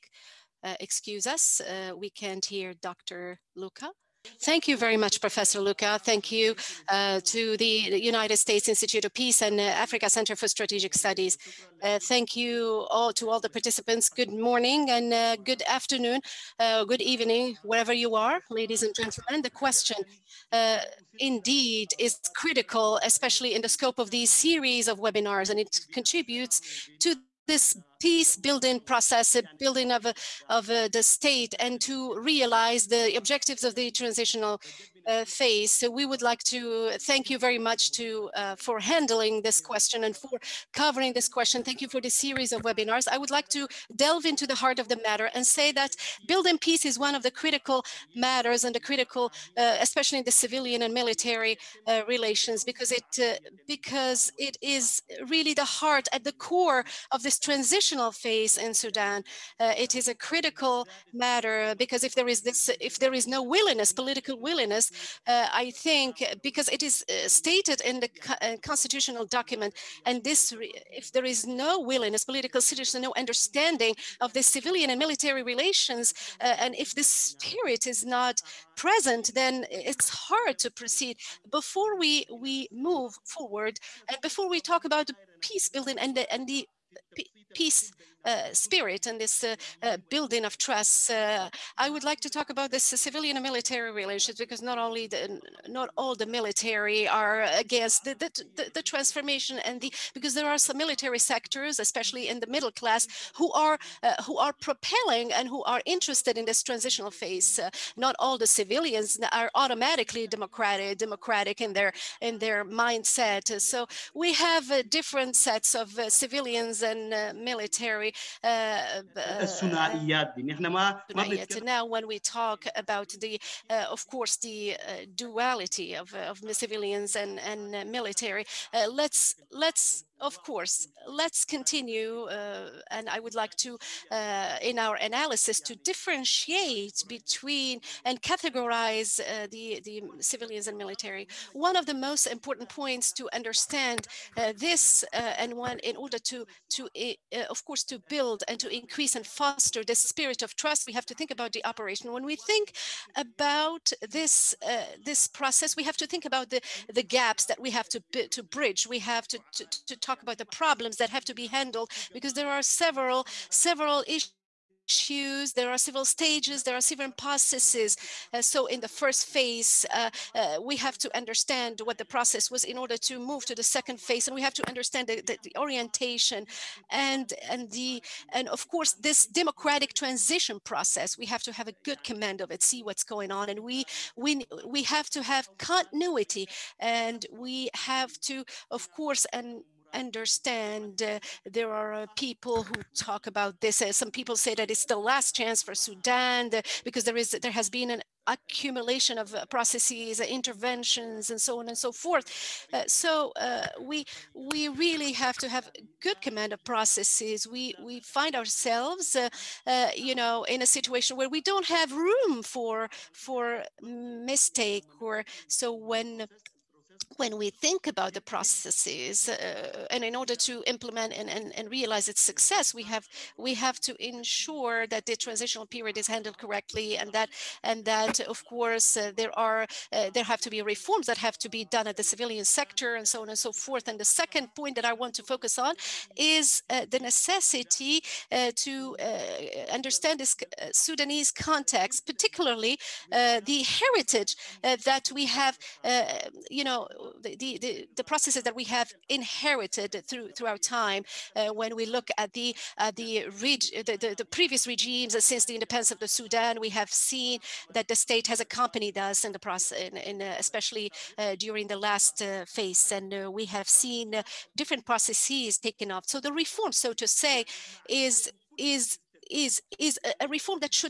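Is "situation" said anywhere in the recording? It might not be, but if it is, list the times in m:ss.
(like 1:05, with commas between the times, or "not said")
3:30.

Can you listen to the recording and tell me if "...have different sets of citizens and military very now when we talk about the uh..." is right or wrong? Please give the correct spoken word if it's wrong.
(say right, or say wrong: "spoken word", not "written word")
wrong: "civilians", not "citizens".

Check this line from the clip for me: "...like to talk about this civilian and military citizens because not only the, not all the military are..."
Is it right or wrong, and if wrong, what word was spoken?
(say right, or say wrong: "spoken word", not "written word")
wrong: "relations", not "citizens".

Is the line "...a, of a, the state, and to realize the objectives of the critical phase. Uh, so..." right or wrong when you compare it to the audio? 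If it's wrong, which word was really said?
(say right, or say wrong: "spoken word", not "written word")
wrong: "transitional", not "critical".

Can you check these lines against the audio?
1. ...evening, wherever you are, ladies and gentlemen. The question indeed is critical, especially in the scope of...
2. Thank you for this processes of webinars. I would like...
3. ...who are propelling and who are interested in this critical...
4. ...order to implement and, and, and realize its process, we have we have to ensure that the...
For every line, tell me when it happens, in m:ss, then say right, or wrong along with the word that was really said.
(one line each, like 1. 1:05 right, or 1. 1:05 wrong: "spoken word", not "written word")
1. 0:17 right
2. 0:41 wrong: "series", not "processes"
3. 1:44 wrong: "transitional", not "critical"
4. 3:40 wrong: "success", not "process".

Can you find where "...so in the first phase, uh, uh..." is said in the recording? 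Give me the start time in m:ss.
2:48.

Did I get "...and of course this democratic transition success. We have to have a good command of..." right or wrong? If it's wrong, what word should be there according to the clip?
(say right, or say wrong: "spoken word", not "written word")
wrong: "process", not "success".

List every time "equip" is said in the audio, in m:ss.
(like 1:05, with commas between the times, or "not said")
not said.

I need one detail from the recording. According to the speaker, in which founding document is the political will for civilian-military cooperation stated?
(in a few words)
constitutional document.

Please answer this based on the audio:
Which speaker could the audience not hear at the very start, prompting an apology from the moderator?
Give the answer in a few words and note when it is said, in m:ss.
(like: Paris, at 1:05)
Dr. Luca, at 0:02.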